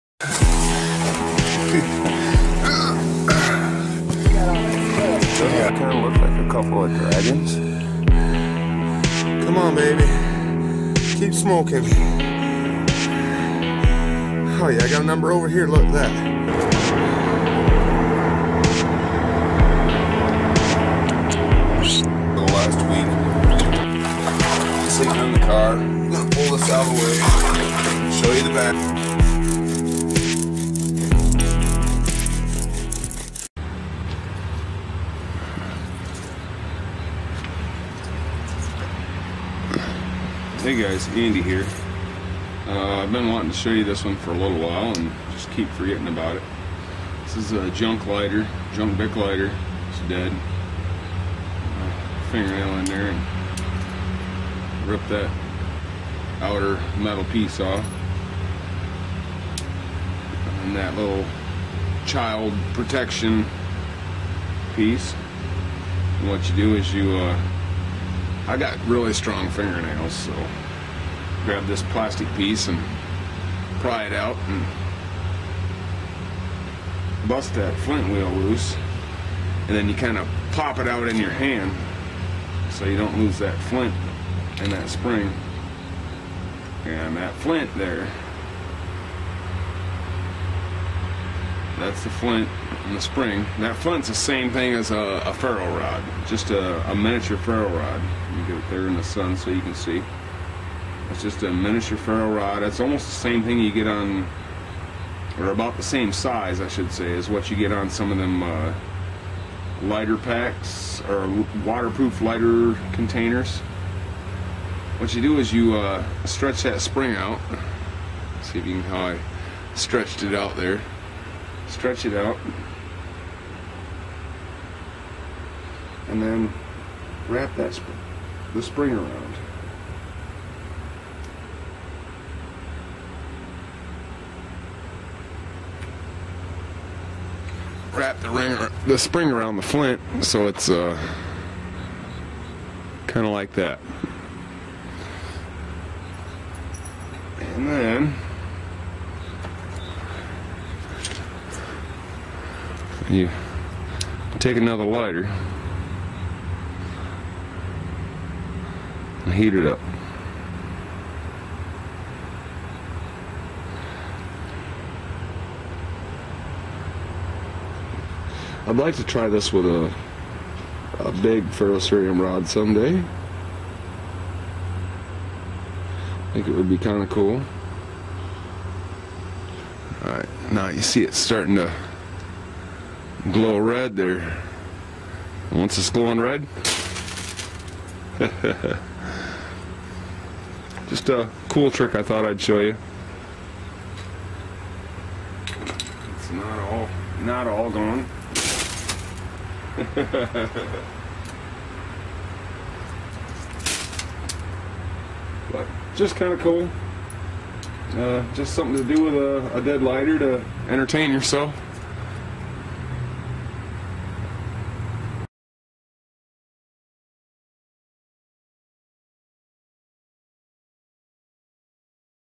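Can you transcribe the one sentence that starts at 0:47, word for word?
This is a junk lighter, junk bic lighter.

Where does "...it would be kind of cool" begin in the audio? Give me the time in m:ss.
2:56.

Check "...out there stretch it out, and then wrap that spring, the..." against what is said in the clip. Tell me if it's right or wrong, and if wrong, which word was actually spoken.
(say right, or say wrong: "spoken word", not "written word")
right.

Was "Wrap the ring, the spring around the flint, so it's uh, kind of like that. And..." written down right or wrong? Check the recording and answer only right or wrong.
right.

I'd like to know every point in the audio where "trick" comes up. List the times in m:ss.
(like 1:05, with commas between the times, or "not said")
3:11.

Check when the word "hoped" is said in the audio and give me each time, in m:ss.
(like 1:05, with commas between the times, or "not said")
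not said.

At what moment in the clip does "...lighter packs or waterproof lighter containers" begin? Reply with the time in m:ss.
1:49.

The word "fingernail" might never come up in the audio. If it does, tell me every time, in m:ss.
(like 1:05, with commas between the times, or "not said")
0:52, 1:09.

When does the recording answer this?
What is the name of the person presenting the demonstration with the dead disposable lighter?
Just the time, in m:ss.
0:41.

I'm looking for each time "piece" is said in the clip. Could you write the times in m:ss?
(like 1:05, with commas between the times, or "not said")
0:57, 1:04, 1:12.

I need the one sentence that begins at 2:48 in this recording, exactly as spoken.
I'd like to try this with a, a big ferrocerium rod someday.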